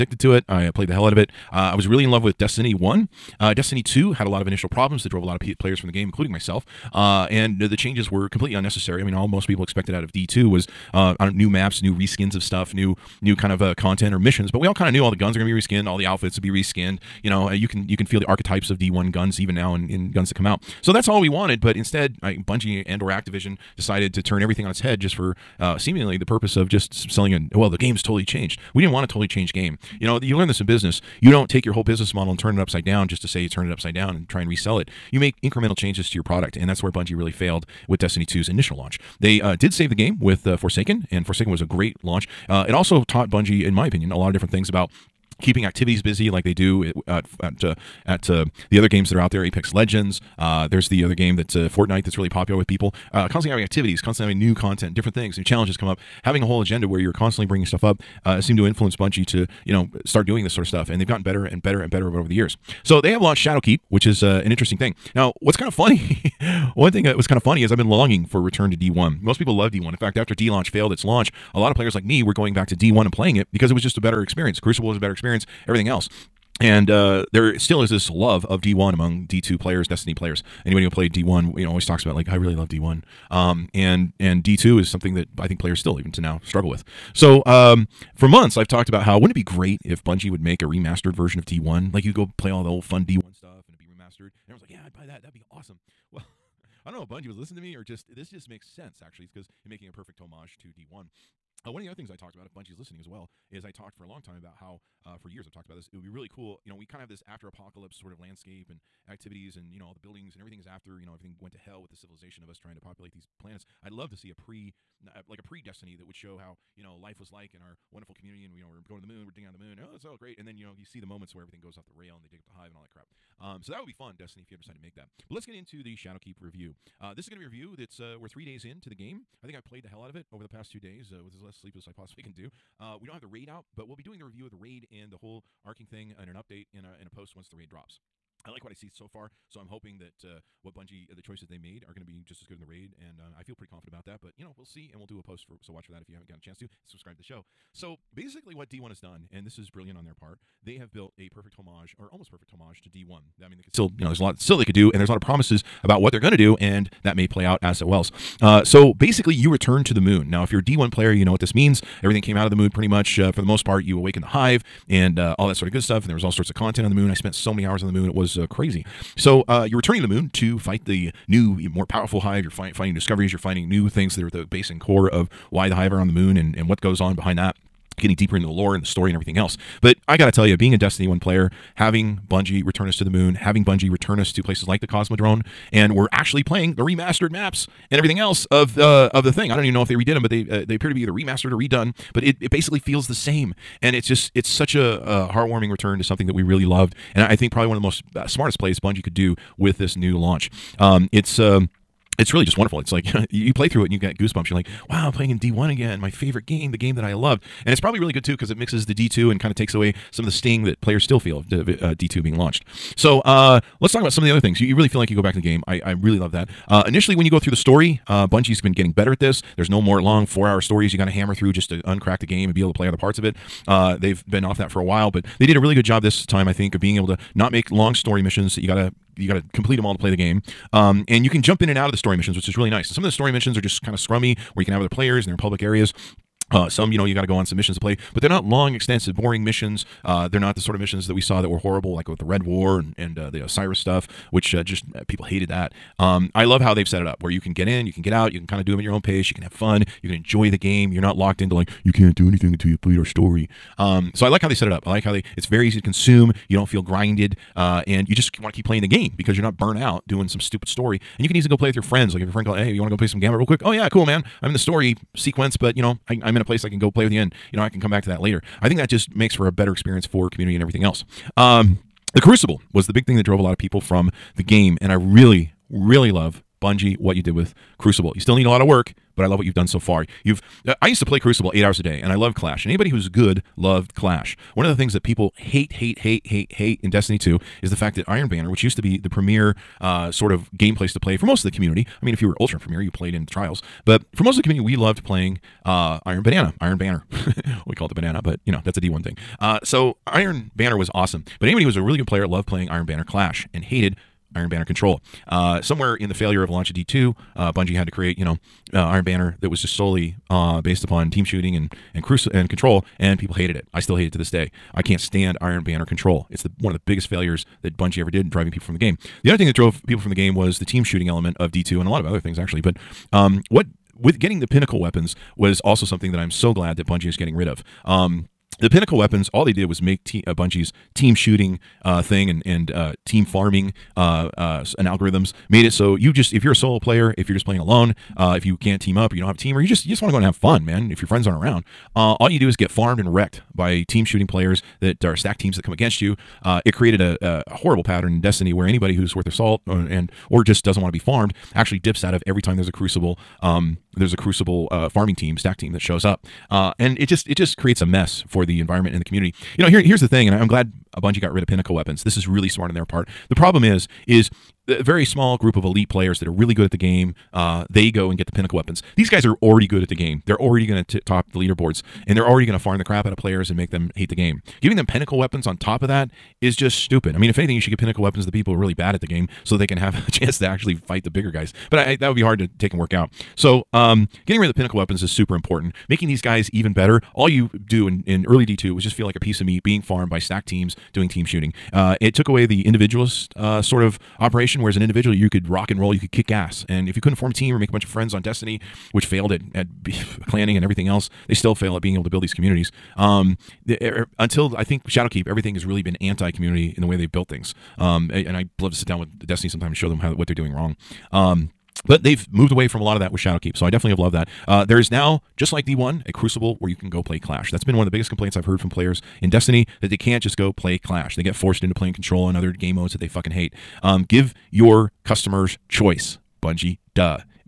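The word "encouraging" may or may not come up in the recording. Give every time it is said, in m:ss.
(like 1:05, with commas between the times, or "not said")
not said.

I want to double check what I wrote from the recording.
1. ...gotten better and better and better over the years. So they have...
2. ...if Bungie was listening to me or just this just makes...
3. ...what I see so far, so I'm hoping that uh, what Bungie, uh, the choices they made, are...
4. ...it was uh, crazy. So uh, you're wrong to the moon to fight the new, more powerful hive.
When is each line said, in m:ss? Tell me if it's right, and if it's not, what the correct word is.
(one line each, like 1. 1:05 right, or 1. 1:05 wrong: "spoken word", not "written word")
1. 1:01 right
2. 1:37 right
3. 2:18 right
4. 2:48 wrong: "returning", not "wrong".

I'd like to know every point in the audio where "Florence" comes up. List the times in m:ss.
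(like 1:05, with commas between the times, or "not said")
not said.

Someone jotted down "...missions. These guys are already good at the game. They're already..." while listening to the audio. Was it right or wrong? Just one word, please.
wrong.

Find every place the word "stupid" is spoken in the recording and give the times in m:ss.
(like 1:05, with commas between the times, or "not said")
4:20, 6:16.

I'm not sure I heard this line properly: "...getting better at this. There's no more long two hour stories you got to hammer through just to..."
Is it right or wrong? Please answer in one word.
wrong.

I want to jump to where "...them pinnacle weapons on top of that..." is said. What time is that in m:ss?
6:14.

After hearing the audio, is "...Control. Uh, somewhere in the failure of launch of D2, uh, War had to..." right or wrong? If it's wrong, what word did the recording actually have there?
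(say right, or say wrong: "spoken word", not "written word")
wrong: "Bungie", not "War".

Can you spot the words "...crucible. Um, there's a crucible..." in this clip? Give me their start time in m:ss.
5:52.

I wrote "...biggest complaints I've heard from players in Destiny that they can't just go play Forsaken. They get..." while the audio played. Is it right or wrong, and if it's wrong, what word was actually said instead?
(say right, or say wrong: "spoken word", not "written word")
wrong: "Clash", not "Forsaken".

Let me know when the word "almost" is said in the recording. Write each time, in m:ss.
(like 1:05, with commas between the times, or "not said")
2:32.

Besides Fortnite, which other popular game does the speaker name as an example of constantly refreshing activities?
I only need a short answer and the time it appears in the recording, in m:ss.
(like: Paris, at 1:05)
Apex Legends, at 0:49.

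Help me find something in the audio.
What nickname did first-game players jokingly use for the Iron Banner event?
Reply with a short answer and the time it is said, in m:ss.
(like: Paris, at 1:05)
the banana, at 4:57.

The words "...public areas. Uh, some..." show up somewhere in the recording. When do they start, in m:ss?
3:55.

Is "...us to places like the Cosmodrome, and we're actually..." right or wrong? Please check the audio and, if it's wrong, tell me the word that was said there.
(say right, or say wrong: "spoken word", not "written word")
right.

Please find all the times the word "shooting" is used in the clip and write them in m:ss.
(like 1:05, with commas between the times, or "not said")
5:11, 5:20, 5:31, 5:44, 6:31.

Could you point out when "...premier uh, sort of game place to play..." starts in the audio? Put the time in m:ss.
4:49.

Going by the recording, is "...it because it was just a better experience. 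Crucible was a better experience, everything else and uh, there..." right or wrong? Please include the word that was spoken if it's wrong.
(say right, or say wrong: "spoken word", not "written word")
right.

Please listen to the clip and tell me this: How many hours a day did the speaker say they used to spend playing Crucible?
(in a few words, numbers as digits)
8.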